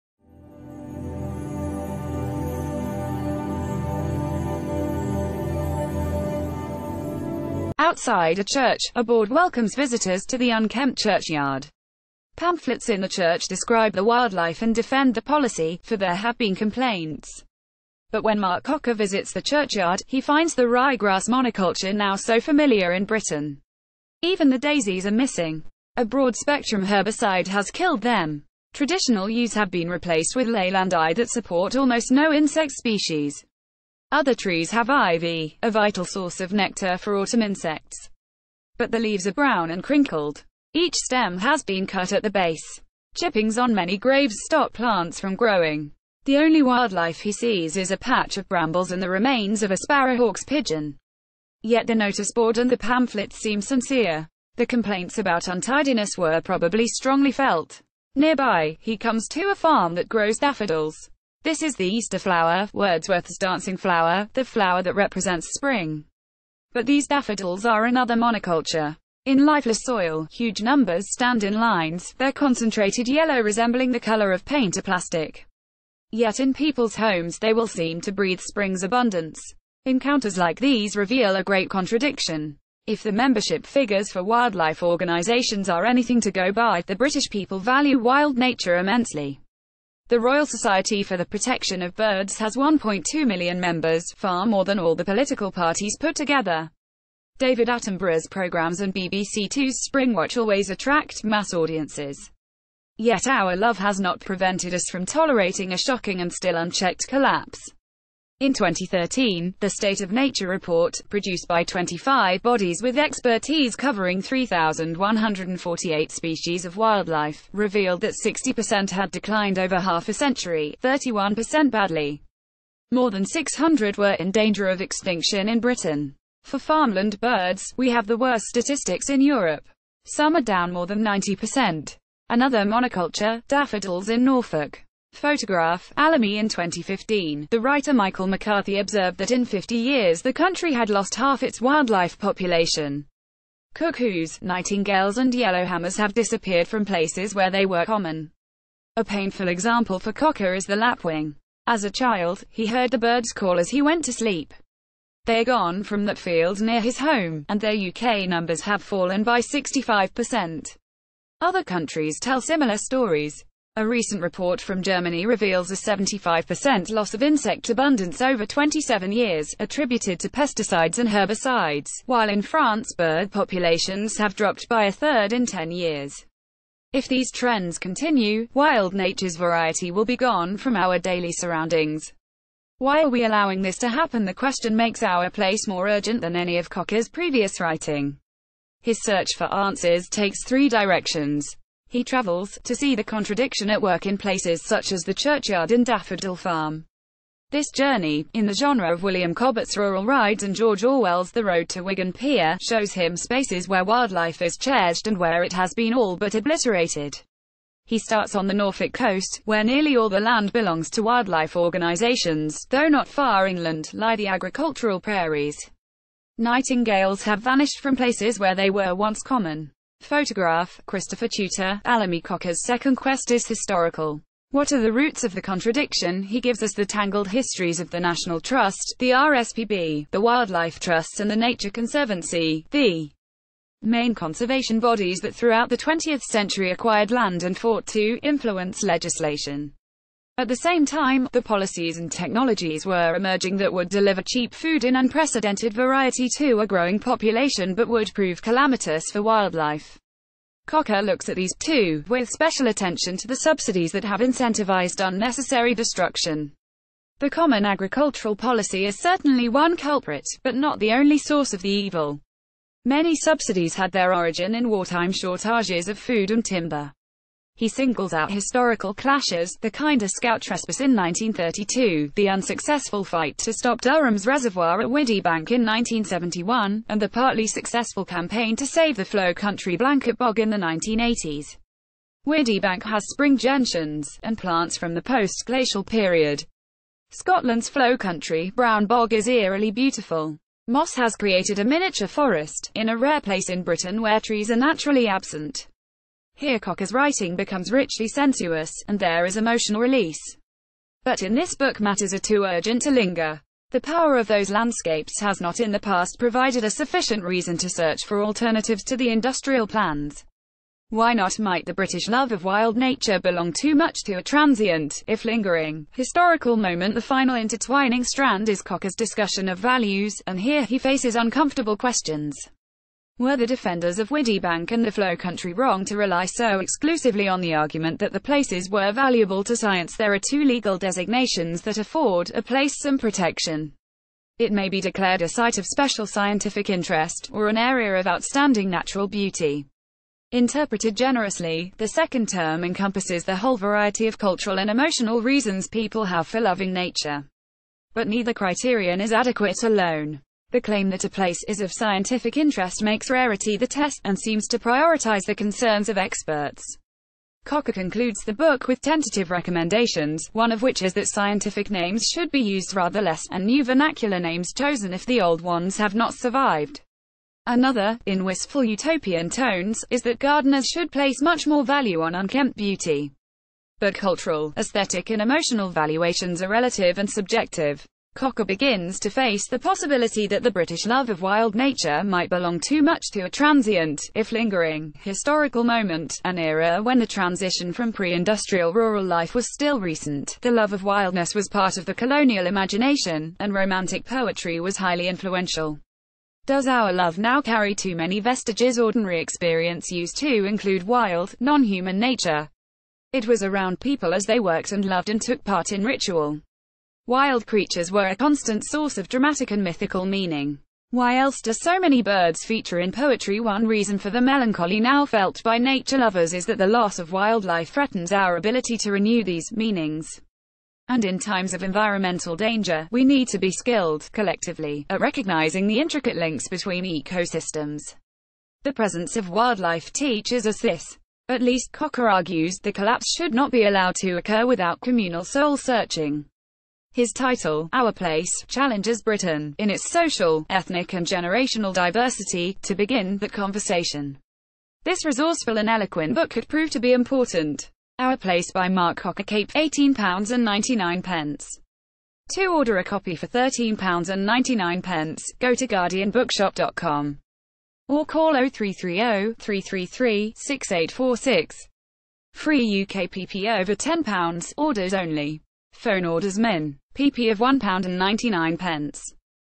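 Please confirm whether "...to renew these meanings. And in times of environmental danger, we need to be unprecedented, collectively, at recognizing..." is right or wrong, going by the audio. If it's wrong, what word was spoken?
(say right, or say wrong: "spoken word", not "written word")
wrong: "skilled", not "unprecedented".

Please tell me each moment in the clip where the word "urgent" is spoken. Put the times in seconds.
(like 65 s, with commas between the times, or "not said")
185 s, 302 s.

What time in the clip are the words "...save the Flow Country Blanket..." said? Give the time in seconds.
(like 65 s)
278 s.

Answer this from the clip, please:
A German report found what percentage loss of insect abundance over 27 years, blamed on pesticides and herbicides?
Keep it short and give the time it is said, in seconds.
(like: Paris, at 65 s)
75%, at 165 s.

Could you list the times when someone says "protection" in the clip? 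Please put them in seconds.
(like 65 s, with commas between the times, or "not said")
91 s, 332 s.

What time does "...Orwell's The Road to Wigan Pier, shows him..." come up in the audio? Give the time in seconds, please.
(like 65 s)
200 s.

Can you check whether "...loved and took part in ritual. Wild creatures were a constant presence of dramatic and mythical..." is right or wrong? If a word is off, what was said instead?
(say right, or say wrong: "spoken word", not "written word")
wrong: "source", not "presence".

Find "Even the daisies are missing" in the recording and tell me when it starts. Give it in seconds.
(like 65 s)
24 s.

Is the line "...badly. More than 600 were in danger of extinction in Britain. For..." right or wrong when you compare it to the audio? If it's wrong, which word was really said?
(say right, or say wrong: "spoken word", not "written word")
right.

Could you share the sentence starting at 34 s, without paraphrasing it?
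Other trees have ivy, a vital source of nectar for autumn insects.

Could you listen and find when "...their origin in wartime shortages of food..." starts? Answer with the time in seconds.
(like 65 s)
263 s.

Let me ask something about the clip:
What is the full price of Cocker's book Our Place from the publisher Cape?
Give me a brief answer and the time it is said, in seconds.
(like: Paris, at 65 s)
£18.99, at 449 s.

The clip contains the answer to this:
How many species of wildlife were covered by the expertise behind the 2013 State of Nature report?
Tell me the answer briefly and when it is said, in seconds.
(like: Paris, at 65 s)
3,148, at 114 s.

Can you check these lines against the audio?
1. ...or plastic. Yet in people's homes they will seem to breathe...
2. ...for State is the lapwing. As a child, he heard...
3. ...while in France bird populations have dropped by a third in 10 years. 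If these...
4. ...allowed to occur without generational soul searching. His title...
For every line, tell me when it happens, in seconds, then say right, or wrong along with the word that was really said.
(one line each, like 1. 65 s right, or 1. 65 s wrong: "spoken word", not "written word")
1. 74 s right
2. 149 s wrong: "Cocker", not "State"
3. 172 s right
4. 433 s wrong: "communal", not "generational".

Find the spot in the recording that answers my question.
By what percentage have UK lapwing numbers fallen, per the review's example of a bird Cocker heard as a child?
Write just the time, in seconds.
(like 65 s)
159 s.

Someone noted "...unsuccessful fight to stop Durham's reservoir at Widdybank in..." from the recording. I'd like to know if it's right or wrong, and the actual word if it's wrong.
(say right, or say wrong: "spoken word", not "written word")
right.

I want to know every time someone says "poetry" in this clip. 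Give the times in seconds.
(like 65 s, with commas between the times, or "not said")
394 s, 412 s.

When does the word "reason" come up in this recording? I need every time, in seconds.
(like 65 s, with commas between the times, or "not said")
307 s, 345 s, 413 s.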